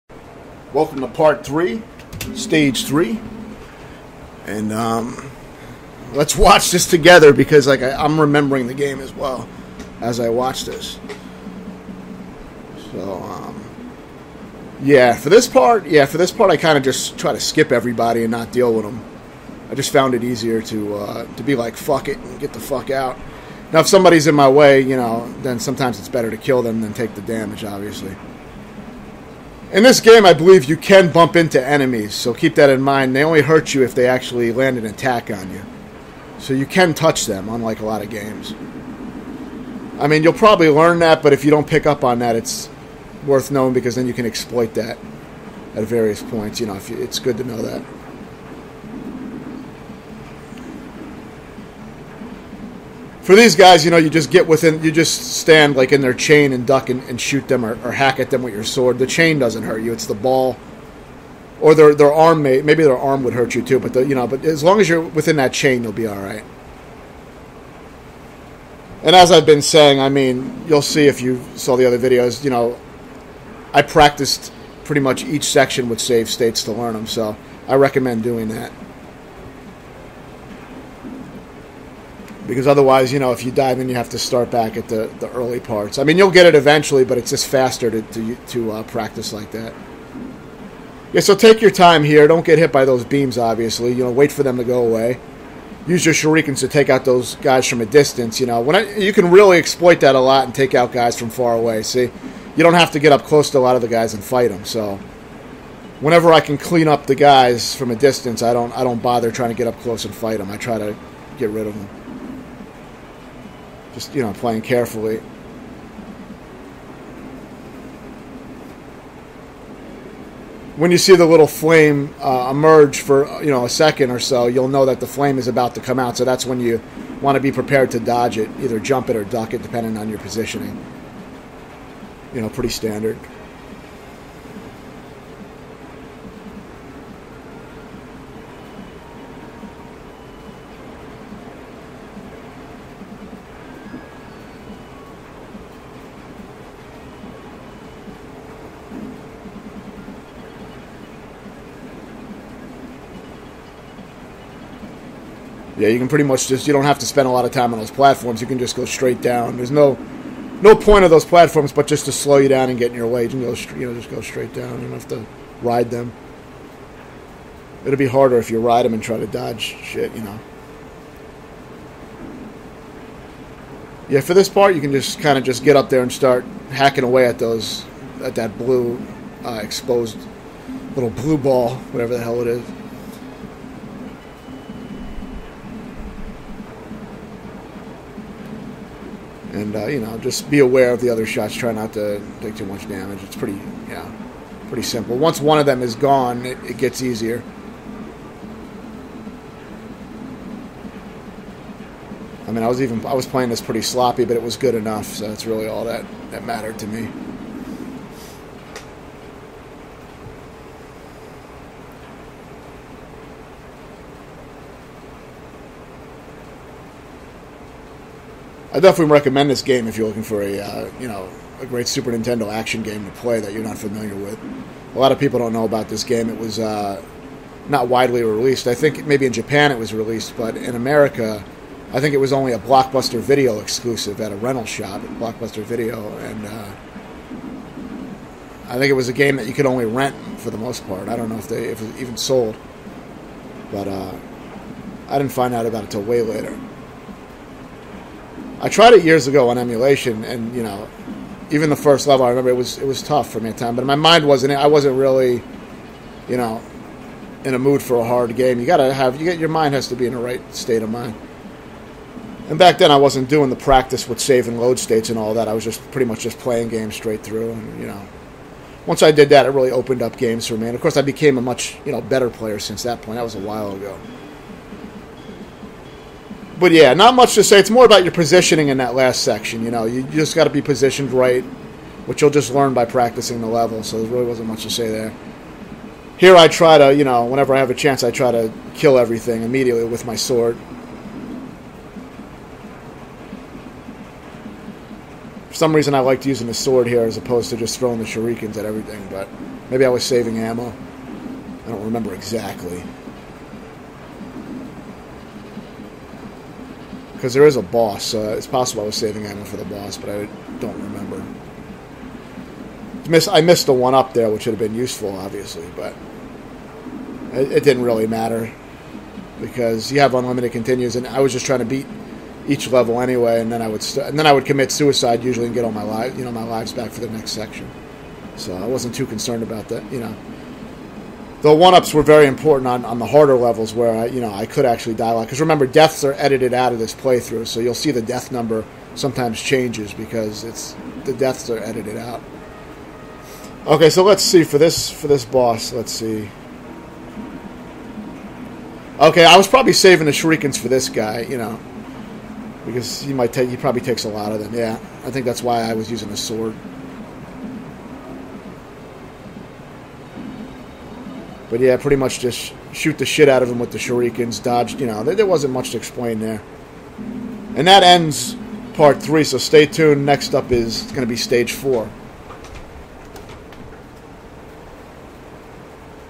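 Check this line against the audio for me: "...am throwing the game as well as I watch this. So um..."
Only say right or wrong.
wrong.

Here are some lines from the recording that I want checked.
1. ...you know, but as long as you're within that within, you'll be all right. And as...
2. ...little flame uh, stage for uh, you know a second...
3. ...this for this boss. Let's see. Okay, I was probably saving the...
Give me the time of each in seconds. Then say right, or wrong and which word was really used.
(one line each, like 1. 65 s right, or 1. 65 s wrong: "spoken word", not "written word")
1. 64 s wrong: "chain", not "within"
2. 121 s wrong: "emerge", not "stage"
3. 344 s right.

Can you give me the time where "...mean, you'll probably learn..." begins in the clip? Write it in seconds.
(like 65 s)
40 s.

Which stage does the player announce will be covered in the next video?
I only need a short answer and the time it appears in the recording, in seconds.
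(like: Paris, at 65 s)
Stage four, at 371 s.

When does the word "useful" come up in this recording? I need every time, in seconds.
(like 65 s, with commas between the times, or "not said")
314 s.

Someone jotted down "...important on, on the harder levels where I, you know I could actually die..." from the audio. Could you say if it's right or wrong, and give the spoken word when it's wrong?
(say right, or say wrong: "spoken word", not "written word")
right.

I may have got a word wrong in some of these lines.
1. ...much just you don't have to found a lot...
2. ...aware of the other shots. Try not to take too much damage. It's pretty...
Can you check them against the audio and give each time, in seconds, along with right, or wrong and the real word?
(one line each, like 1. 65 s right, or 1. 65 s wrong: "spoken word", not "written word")
1. 156 s wrong: "spend", not "found"
2. 190 s right.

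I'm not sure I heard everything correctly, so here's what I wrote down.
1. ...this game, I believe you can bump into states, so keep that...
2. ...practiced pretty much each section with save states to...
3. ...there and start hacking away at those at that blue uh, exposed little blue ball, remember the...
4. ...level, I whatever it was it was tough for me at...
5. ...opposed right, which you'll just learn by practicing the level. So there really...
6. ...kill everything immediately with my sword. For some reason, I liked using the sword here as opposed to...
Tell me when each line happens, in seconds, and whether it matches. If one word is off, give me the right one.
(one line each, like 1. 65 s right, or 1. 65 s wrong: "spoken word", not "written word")
1. 29 s wrong: "enemies", not "states"
2. 73 s right
3. 175 s wrong: "whatever", not "remember"
4. 252 s wrong: "remember", not "whatever"
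5. 280 s wrong: "positioned", not "opposed"
6. 288 s right.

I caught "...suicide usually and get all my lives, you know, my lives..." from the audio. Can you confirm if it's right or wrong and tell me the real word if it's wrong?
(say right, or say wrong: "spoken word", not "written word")
right.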